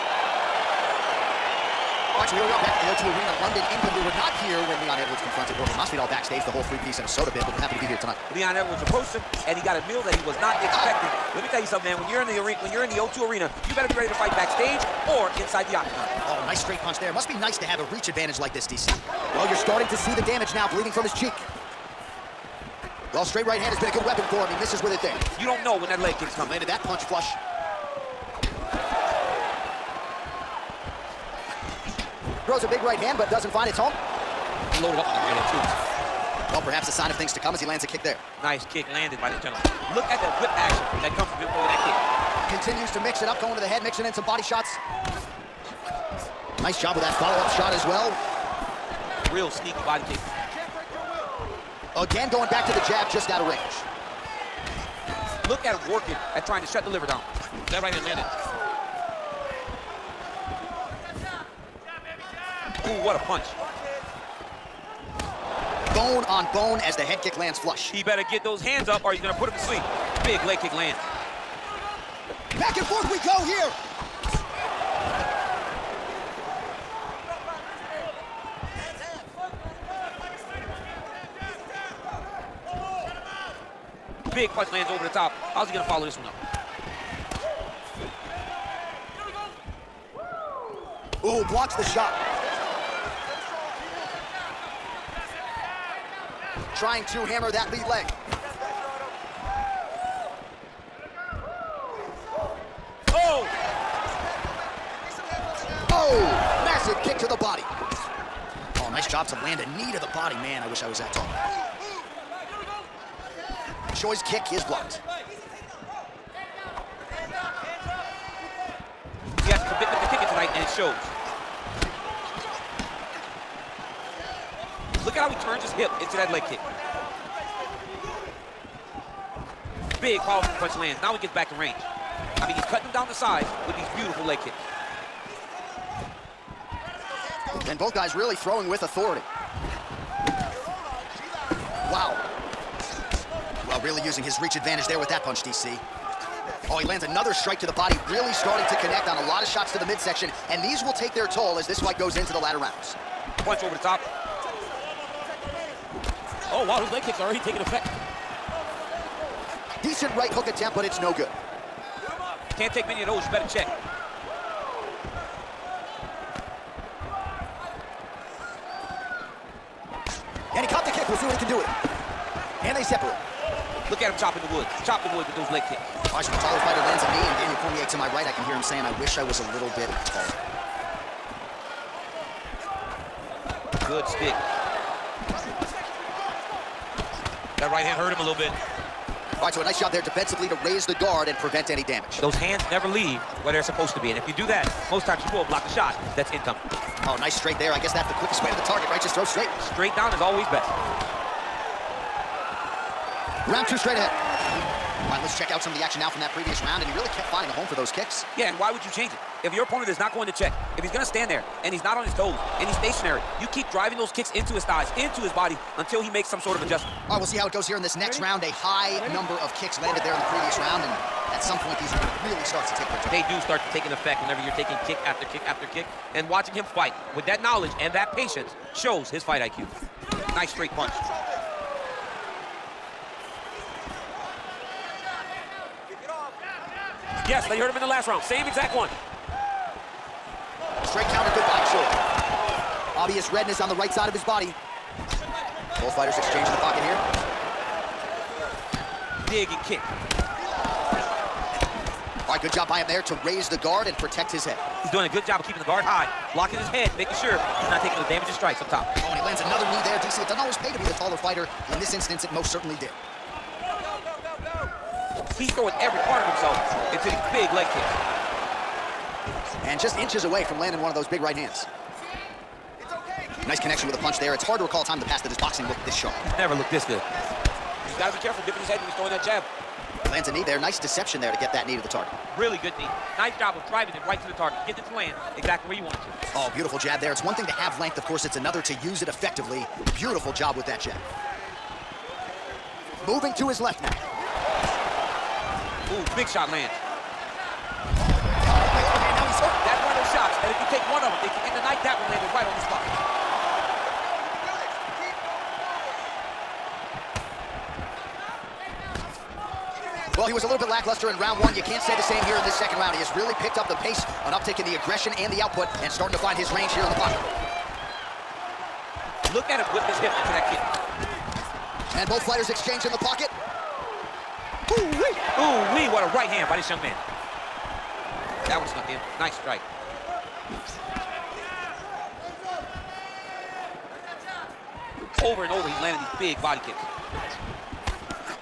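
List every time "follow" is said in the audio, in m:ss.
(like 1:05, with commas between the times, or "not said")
0:47, 1:25.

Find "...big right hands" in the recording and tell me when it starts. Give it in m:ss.
4:31.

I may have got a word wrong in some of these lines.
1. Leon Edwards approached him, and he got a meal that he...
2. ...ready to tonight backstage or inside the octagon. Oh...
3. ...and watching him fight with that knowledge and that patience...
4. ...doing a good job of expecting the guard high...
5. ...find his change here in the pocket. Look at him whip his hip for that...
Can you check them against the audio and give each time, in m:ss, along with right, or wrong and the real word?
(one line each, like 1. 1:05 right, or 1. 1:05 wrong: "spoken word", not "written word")
1. 0:08 right
2. 0:13 wrong: "fight", not "tonight"
3. 3:46 right
4. 4:14 wrong: "keeping", not "expecting"
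5. 5:16 wrong: "range", not "change".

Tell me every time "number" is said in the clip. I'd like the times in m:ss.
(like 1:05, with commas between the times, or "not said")
3:39.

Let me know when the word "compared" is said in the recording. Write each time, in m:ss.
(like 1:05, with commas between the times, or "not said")
not said.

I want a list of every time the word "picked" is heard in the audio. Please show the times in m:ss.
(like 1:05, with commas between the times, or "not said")
5:13.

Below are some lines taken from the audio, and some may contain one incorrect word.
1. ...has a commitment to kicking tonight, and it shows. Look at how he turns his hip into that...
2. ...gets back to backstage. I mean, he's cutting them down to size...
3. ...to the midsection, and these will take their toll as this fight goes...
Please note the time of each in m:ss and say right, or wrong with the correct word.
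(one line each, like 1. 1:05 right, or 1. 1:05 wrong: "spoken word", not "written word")
1. 1:59 right
2. 2:11 wrong: "range", not "backstage"
3. 2:29 right.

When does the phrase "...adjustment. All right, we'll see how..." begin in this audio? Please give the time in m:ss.
3:36.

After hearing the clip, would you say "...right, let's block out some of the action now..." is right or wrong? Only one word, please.
wrong.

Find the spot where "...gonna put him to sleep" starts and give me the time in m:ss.
1:09.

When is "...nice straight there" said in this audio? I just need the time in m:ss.
3:17.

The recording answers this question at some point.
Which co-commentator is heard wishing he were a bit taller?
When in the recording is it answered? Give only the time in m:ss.
2:57.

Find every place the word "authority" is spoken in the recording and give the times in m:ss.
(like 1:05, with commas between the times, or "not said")
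2:18.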